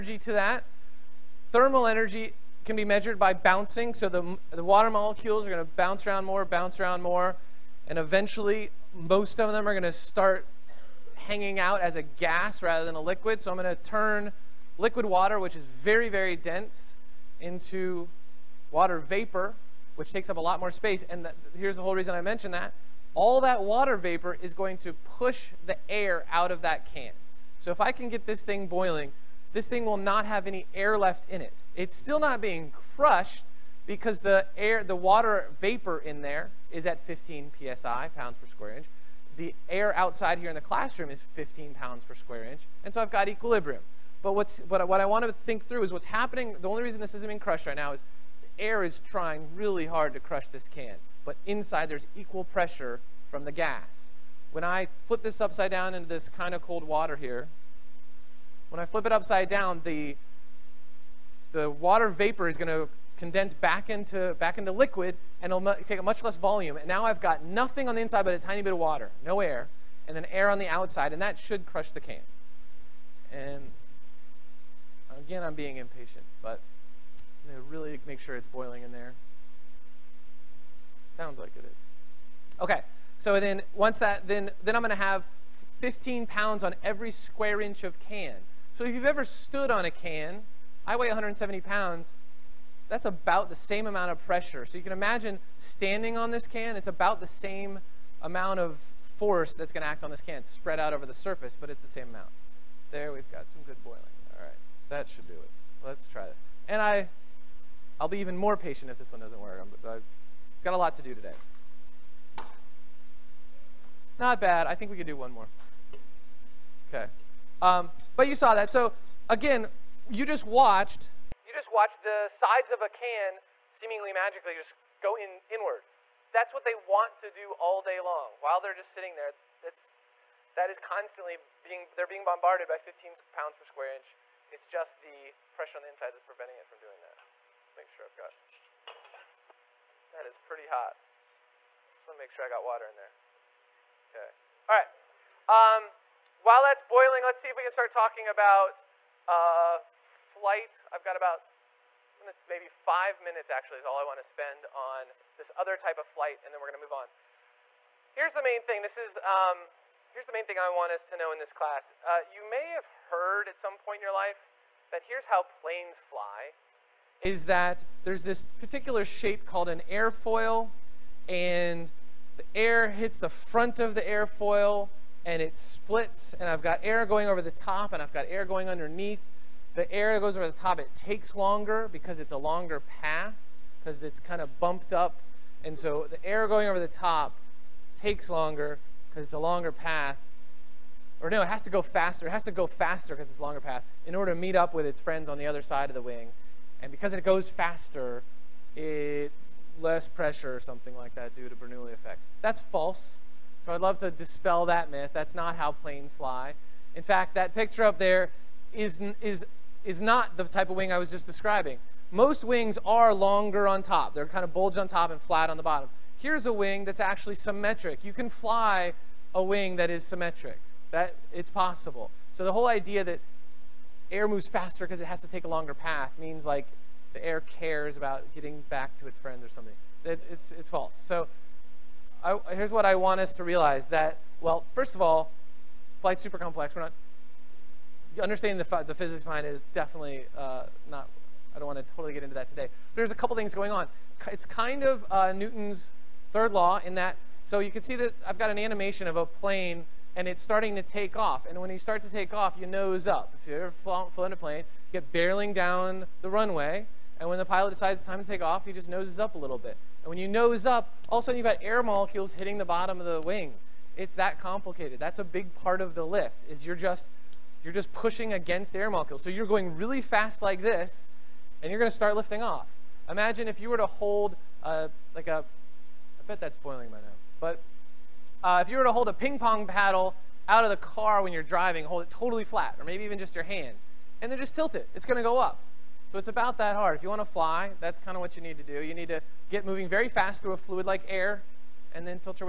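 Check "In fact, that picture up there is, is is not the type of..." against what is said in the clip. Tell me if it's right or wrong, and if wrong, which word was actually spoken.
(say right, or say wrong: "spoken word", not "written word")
right.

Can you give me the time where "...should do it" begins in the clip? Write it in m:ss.
1:45.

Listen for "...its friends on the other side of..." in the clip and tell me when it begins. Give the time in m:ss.
3:14.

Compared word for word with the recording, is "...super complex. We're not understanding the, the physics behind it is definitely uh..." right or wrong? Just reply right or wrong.
right.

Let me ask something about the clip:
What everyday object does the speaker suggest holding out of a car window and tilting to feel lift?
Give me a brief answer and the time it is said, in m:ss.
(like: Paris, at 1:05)
ping pong paddle, at 4:39.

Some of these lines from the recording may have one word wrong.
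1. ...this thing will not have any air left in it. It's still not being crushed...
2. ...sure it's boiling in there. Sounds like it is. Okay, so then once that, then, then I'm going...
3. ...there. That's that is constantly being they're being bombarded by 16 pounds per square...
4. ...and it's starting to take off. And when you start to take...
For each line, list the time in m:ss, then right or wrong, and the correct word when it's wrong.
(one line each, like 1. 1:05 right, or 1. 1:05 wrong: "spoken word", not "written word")
1. 0:29 right
2. 1:18 right
3. 2:09 wrong: "15", not "16"
4. 4:10 right.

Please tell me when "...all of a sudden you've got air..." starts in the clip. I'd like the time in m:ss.
4:21.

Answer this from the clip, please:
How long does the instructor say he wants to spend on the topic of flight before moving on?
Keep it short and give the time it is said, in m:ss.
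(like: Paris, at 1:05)
five minutes, at 2:32.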